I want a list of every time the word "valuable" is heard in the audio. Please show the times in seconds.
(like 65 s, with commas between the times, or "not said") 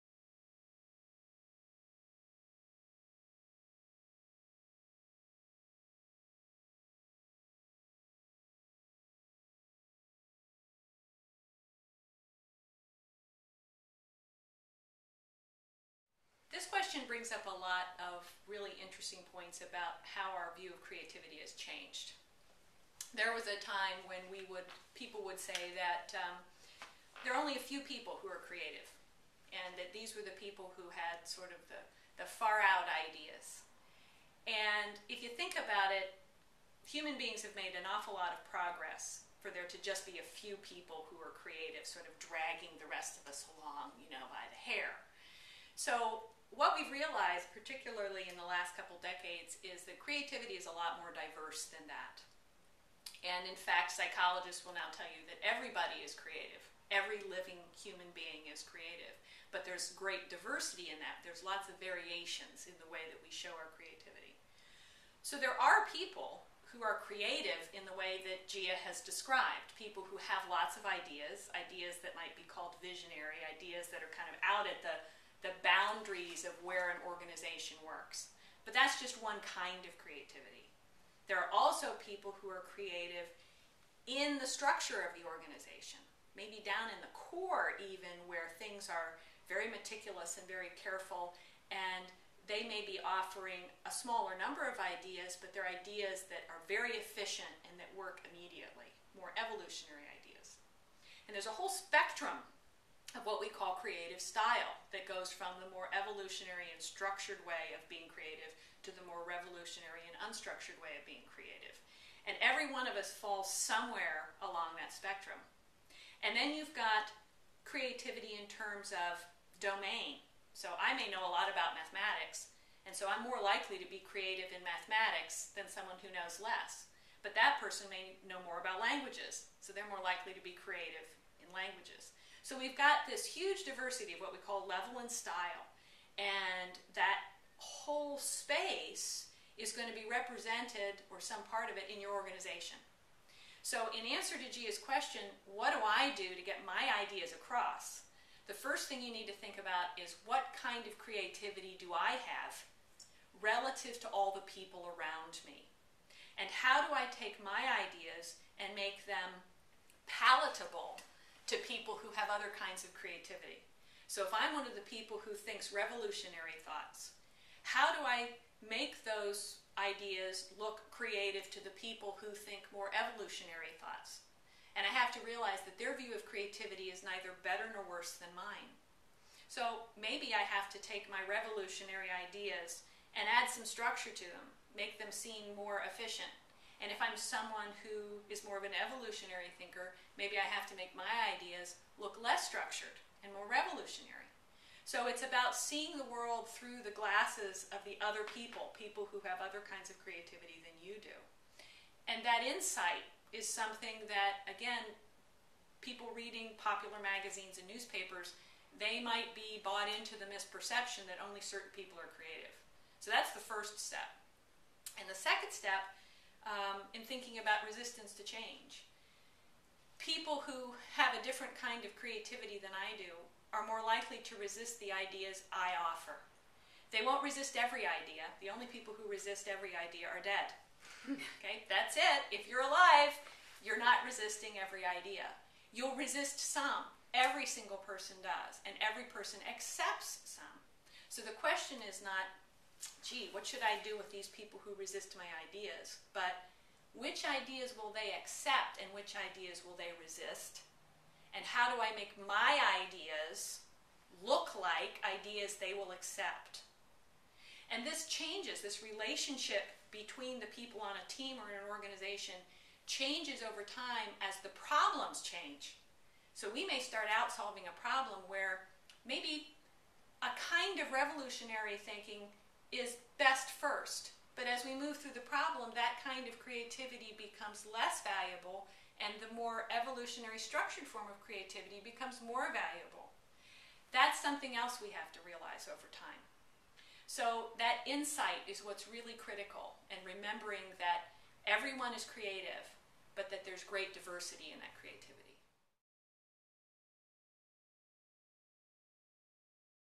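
278 s, 282 s.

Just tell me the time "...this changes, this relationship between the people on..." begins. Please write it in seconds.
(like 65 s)
257 s.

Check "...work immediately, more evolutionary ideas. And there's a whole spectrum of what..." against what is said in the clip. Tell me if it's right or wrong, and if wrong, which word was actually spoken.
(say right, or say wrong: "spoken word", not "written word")
right.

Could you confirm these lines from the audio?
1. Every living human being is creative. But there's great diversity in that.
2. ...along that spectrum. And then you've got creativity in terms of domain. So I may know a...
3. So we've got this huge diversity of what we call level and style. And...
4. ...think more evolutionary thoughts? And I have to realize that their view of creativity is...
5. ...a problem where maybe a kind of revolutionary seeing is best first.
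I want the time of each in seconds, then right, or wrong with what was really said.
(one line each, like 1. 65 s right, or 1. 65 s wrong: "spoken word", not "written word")
1. 56 s right
2. 114 s right
3. 132 s right
4. 172 s right
5. 267 s wrong: "thinking", not "seeing".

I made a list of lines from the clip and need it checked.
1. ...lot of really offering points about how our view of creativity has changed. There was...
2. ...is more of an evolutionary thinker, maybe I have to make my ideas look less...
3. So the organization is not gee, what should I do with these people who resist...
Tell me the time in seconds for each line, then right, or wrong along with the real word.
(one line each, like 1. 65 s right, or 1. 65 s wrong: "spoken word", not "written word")
1. 17 s wrong: "interesting", not "offering"
2. 188 s right
3. 241 s wrong: "question", not "organization".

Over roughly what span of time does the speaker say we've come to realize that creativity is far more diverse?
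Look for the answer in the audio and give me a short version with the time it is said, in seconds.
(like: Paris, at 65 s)
Last couple decades, at 48 s.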